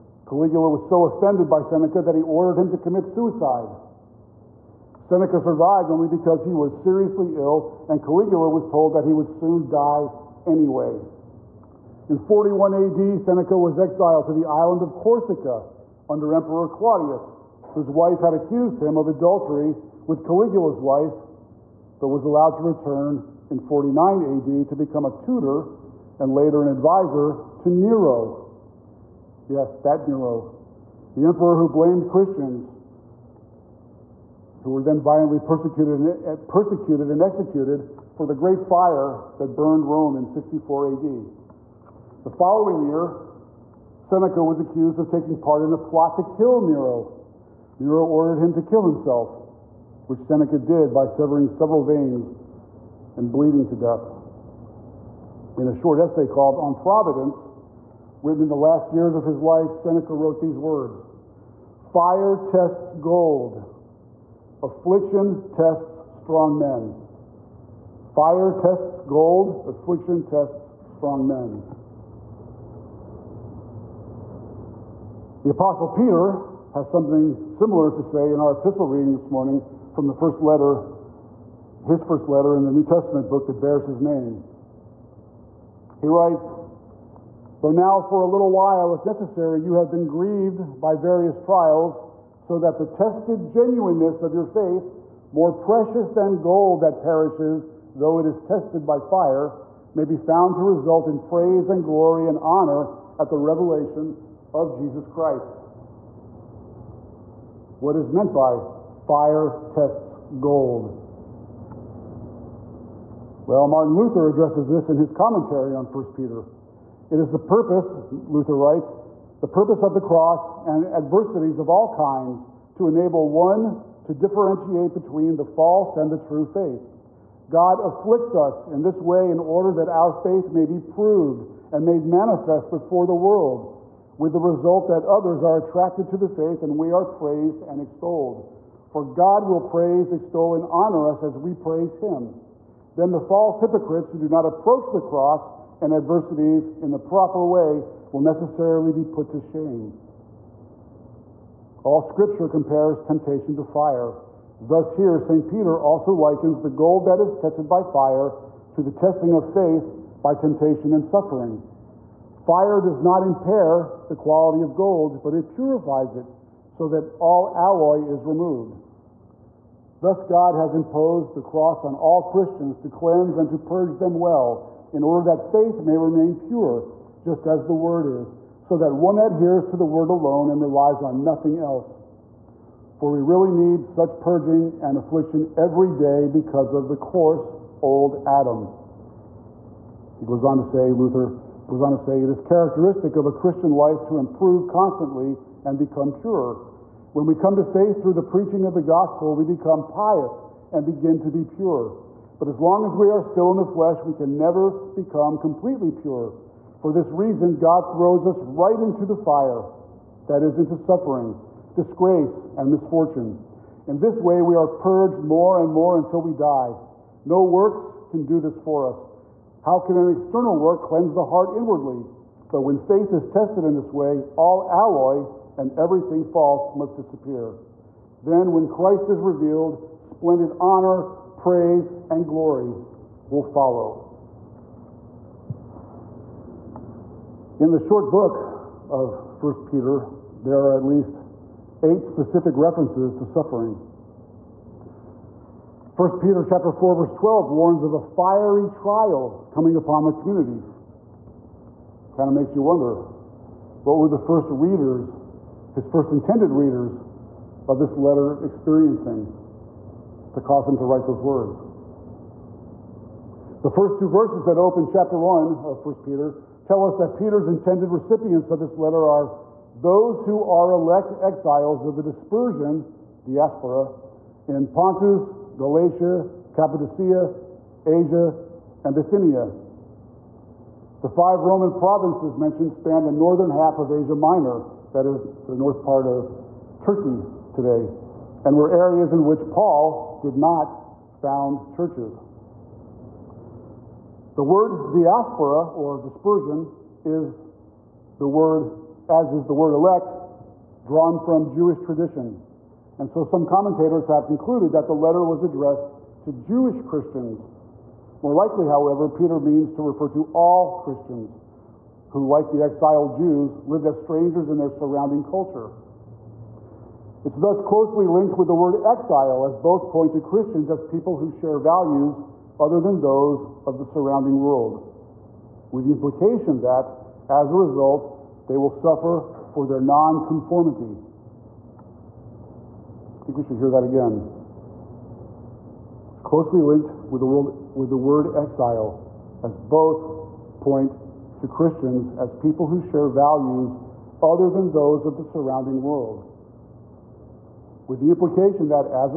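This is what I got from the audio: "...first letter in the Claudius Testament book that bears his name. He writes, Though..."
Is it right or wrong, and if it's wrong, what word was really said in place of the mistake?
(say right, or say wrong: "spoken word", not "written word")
wrong: "New", not "Claudius".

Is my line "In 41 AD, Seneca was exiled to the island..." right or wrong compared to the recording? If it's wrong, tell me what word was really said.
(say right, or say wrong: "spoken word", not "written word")
right.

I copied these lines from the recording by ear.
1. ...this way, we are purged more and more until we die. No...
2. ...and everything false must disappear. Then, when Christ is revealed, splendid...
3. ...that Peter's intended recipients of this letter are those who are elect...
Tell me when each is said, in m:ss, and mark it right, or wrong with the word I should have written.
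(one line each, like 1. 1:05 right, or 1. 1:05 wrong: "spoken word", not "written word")
1. 3:33 right
2. 3:45 right
3. 4:26 right.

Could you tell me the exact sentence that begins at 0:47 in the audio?
Nero ordered him to kill himself which Seneca did by severing several veins and bleeding to death.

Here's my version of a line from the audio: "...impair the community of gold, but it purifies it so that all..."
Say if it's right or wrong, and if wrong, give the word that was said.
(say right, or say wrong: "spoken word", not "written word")
wrong: "quality", not "community".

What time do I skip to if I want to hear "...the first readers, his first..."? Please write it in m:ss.
4:14.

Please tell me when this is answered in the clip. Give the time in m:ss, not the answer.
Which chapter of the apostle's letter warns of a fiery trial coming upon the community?
4:06.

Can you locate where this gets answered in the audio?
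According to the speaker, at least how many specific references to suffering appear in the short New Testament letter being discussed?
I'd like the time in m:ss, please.
4:01.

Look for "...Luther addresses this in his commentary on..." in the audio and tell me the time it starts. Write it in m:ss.
1:53.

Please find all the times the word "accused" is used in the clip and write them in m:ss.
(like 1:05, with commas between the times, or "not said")
0:18, 0:44.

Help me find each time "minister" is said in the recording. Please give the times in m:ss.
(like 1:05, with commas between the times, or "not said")
not said.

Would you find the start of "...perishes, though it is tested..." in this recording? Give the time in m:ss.
1:36.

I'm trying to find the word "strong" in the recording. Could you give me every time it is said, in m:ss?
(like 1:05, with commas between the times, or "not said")
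1:06, 1:10.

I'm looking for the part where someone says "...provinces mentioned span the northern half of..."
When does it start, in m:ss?
4:41.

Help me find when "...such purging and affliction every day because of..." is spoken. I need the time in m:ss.
3:03.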